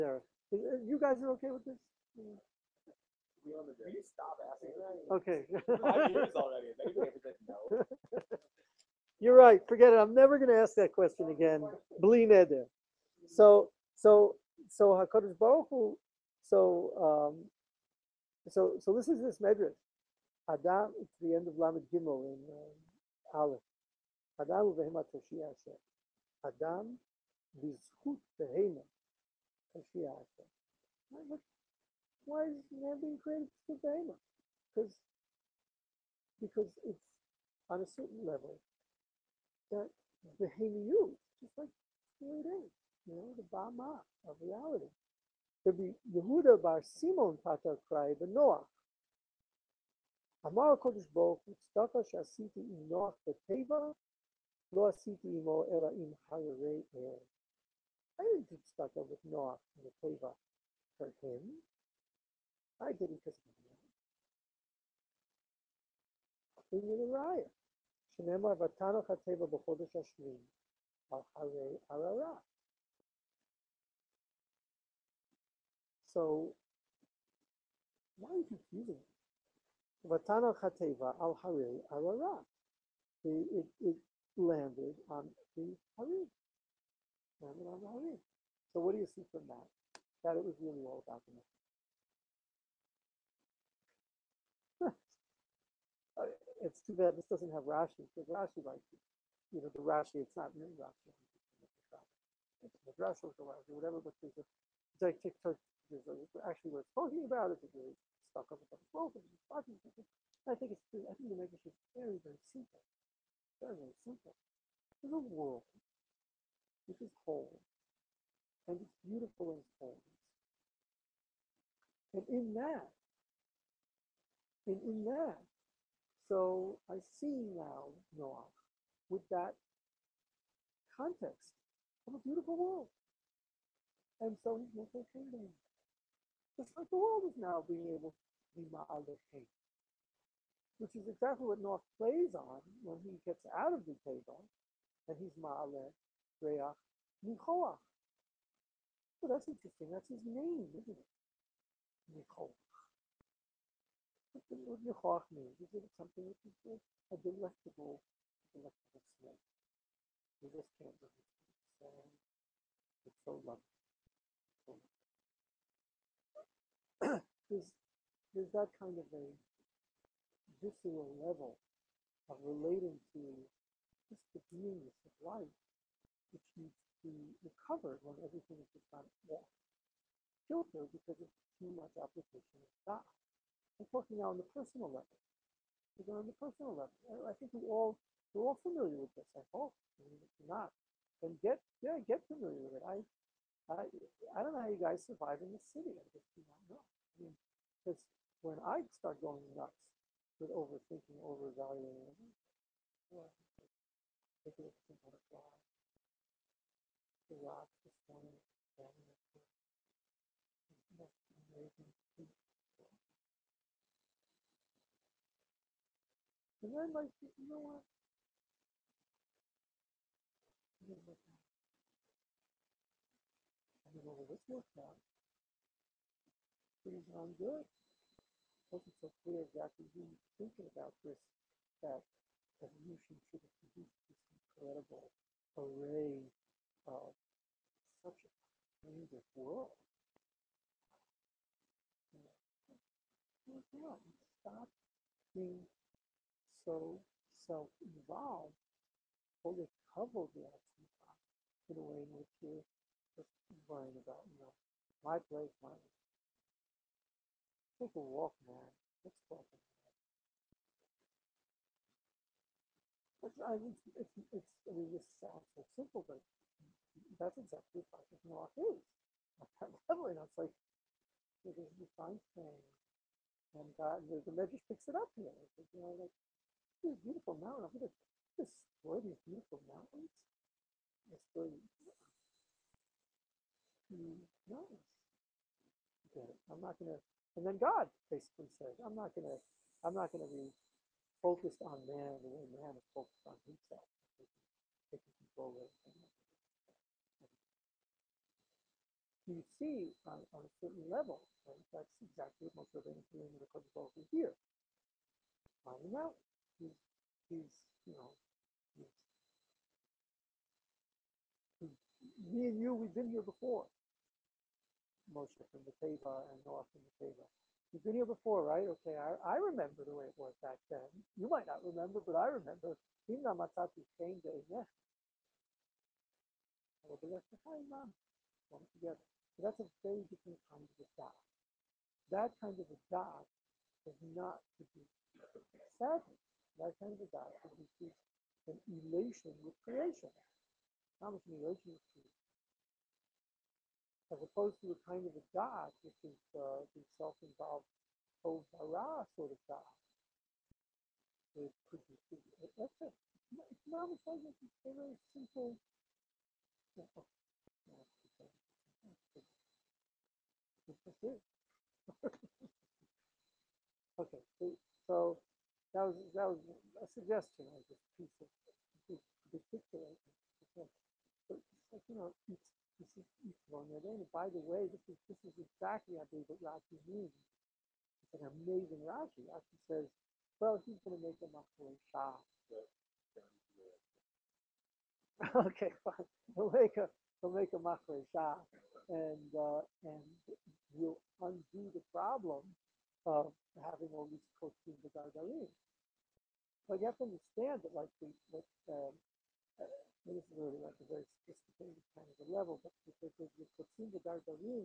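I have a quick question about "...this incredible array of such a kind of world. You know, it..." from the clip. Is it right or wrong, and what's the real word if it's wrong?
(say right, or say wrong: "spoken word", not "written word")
right.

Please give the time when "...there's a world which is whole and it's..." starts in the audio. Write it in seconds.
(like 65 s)
115 s.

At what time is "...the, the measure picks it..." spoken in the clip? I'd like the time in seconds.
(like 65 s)
274 s.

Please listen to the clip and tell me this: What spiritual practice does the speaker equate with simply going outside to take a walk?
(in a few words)
practice walk.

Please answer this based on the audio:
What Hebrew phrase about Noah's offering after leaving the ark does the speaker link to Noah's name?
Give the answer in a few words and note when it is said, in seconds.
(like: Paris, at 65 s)
Reach Nichoach, at 146 s.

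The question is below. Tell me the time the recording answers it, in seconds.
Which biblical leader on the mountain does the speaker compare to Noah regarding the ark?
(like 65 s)
302 s.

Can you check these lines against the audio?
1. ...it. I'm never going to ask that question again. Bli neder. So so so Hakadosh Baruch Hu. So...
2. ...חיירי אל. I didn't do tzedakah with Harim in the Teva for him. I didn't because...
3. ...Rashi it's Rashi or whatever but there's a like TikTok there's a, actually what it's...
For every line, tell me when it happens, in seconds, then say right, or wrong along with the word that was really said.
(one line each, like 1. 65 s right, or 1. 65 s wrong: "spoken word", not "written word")
1. 9 s right
2. 56 s wrong: "Noah", not "Harim"
3. 100 s right.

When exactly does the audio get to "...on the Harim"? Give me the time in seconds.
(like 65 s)
85 s.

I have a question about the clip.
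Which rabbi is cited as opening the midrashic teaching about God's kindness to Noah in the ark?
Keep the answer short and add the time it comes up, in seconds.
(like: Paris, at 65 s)
Rabbi Yehuda bar Simon, at 45 s.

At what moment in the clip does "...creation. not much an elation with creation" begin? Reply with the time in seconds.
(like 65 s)
339 s.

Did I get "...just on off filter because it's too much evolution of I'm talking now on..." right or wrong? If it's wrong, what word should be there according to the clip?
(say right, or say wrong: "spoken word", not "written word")
wrong: "application", not "evolution".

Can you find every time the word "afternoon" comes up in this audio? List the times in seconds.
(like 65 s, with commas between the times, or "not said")
not said.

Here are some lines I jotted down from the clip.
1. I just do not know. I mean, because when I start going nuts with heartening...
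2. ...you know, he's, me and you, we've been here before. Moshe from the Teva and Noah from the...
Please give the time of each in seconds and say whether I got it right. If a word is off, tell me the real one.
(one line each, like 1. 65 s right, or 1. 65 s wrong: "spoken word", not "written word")
1. 195 s wrong: "overthinking", not "heartening"
2. 307 s right.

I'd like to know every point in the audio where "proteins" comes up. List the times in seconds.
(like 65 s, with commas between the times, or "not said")
394 s, 403 s.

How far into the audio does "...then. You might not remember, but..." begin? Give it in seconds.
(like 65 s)
320 s.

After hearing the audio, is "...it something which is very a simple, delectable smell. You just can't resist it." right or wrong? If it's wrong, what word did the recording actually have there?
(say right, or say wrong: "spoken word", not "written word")
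wrong: "delectable", not "simple".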